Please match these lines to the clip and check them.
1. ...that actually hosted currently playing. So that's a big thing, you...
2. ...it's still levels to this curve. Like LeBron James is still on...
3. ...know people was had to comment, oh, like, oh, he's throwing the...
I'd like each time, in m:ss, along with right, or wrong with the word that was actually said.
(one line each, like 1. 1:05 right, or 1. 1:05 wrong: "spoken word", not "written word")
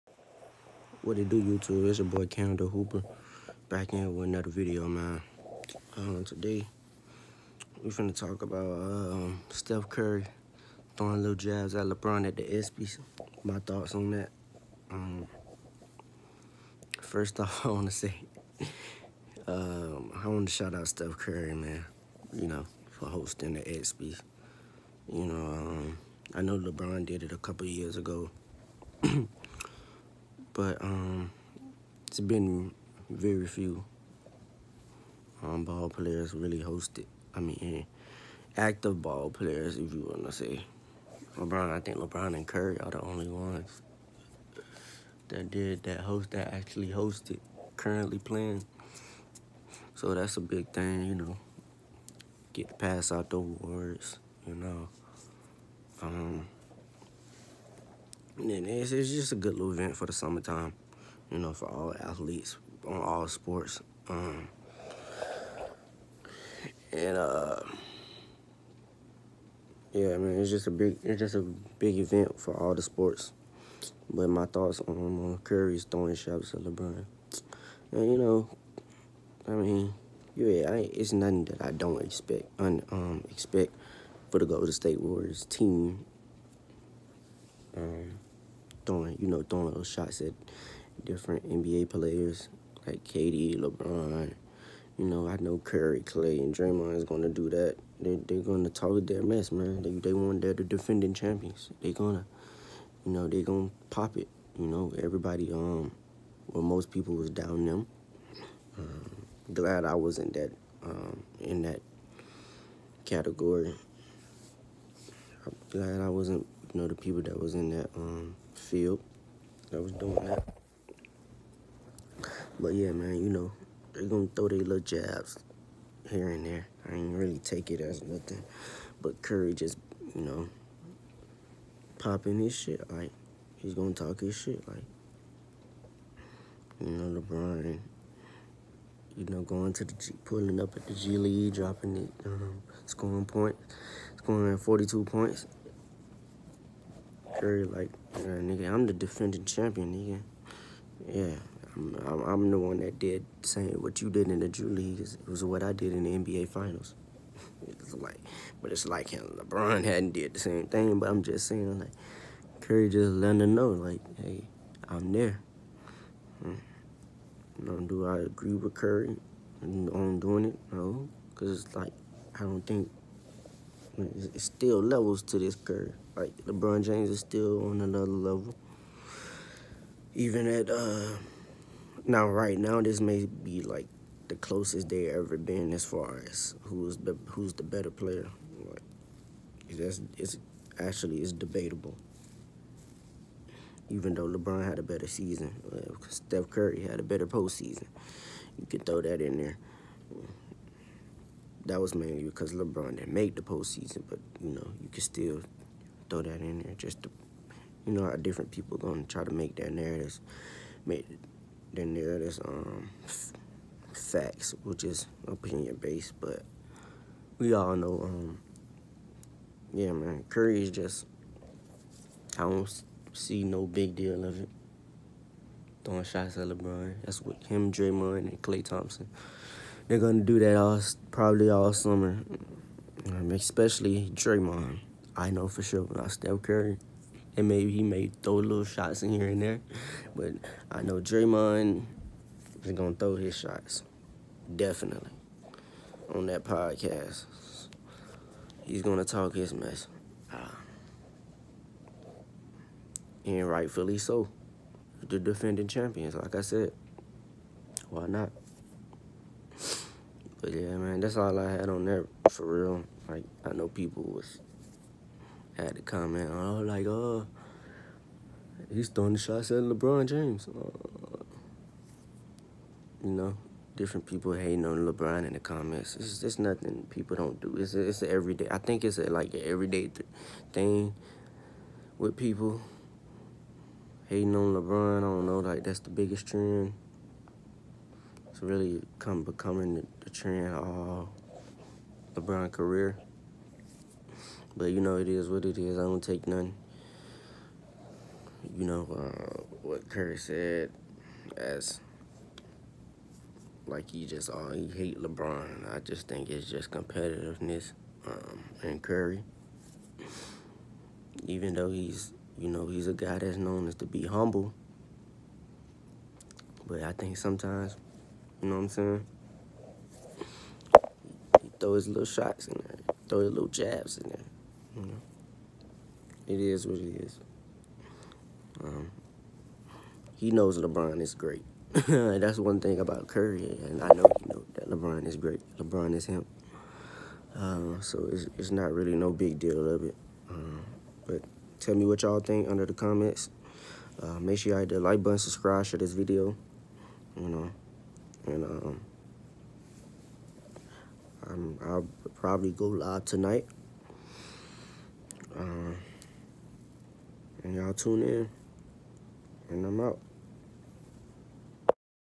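1. 0:46 right
2. 2:54 right
3. 4:23 right.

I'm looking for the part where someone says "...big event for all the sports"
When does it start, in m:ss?
1:11.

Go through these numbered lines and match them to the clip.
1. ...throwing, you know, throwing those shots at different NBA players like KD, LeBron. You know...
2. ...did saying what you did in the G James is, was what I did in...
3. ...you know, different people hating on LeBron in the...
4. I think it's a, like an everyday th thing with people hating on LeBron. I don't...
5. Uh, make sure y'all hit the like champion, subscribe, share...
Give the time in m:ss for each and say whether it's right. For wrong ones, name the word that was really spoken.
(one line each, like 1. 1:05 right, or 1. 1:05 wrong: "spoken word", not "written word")
1. 1:28 right
2. 2:32 wrong: "League", not "James"
3. 4:33 right
4. 4:38 right
5. 5:44 wrong: "button", not "champion".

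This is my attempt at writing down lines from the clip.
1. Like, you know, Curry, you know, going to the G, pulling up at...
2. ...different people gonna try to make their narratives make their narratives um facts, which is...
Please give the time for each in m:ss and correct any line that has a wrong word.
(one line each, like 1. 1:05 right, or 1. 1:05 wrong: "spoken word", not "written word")
1. 2:14 wrong: "LeBron", not "Curry"
2. 3:28 right.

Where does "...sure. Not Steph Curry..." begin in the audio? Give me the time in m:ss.
3:55.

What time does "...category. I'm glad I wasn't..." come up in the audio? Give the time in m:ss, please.
1:53.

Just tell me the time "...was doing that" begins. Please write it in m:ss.
1:59.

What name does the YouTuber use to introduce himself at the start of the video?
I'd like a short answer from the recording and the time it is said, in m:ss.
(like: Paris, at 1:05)
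Canada Hooper, at 0:02.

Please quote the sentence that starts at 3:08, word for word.
Like that's it's actually it's debatable.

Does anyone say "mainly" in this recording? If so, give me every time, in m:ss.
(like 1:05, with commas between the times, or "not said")
3:21.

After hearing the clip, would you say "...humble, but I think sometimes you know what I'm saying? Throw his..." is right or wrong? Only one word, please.
right.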